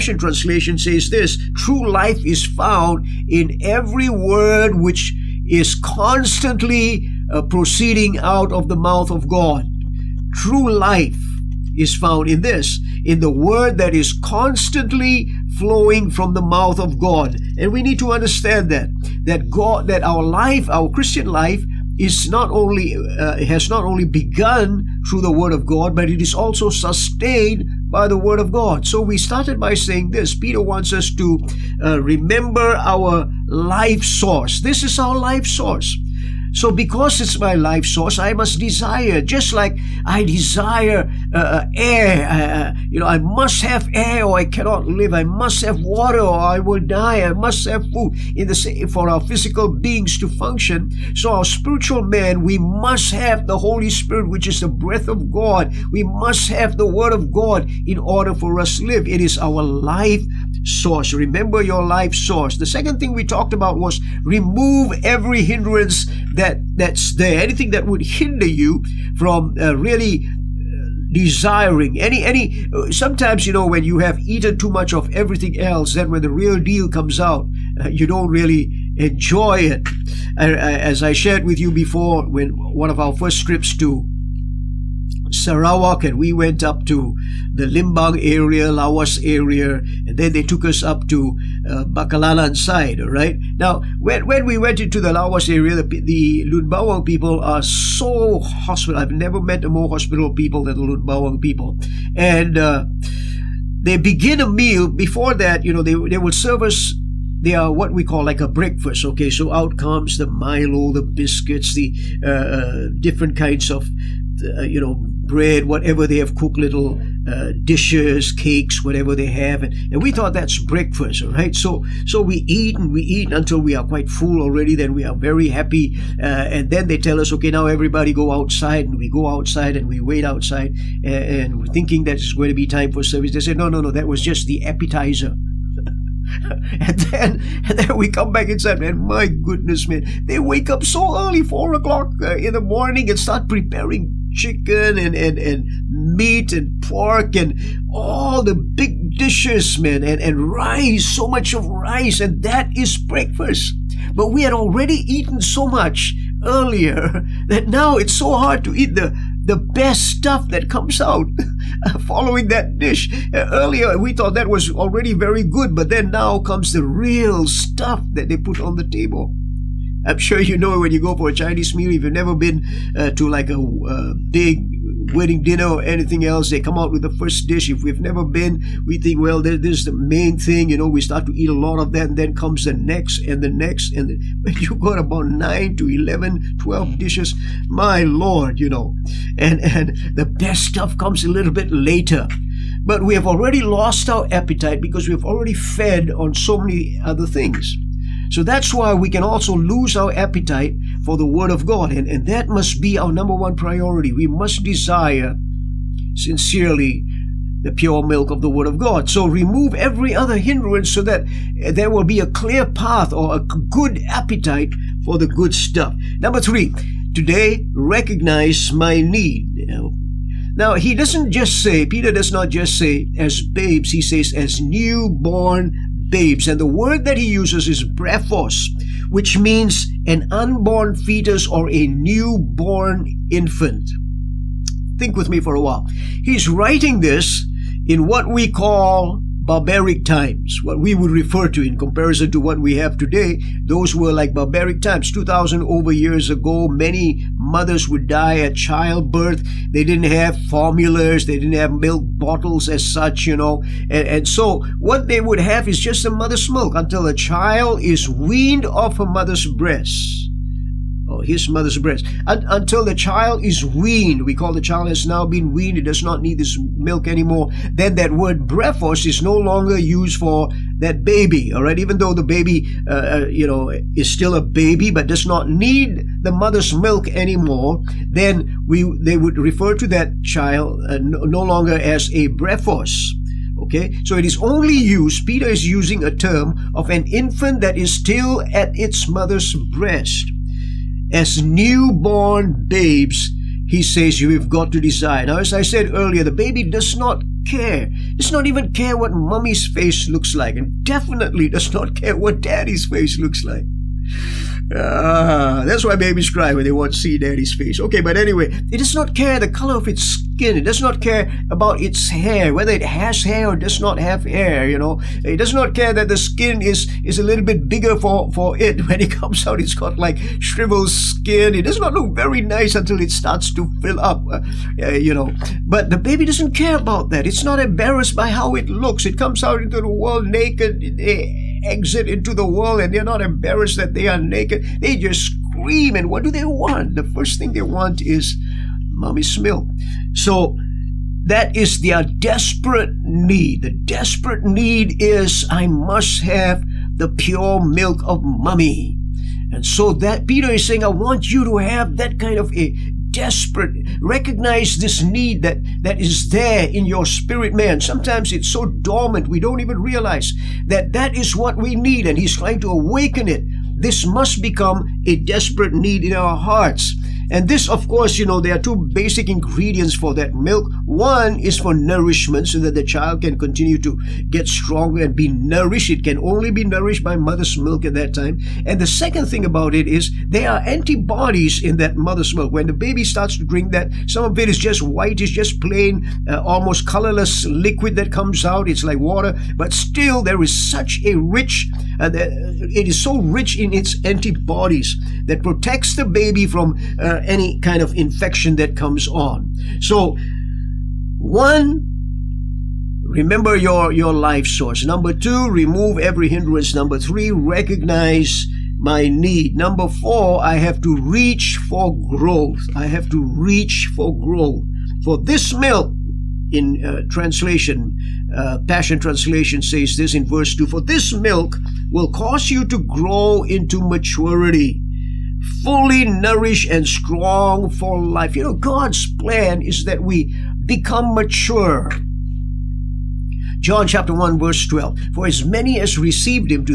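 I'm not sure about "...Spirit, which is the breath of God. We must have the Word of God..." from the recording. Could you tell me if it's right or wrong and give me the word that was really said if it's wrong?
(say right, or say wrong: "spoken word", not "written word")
right.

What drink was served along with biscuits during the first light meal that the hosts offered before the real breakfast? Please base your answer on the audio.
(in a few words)
Milo.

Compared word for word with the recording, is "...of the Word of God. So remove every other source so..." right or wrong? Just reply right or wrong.
wrong.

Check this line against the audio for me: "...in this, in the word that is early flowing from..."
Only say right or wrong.
wrong.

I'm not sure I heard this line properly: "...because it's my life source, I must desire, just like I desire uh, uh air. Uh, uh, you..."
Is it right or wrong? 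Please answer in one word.
right.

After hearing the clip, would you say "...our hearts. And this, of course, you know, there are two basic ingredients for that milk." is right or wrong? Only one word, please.
right.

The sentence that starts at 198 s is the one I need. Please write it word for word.
So that's why we can also lose our appetite for the Word of God.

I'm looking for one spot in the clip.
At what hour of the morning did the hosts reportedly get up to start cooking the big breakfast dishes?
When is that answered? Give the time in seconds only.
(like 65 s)
141 s.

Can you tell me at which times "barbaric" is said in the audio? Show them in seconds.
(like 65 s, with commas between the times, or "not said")
239 s, 244 s.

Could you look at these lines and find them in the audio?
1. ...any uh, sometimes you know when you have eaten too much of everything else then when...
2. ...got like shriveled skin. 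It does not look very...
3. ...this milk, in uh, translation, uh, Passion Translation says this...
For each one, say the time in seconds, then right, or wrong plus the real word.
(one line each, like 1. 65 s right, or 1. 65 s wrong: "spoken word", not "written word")
1. 72 s right
2. 319 s right
3. 415 s right.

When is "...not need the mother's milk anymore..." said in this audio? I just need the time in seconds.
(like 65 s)
275 s.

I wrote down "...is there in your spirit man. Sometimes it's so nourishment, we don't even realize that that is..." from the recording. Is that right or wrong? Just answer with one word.
wrong.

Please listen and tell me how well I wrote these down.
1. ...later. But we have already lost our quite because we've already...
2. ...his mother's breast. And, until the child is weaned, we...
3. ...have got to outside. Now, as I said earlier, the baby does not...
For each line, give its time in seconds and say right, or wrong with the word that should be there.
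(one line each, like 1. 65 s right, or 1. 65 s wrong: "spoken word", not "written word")
1. 191 s wrong: "appetite", not "quite"
2. 261 s right
3. 294 s wrong: "decide", not "outside".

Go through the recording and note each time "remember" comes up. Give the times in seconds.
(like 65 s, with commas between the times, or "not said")
32 s, 61 s, 403 s.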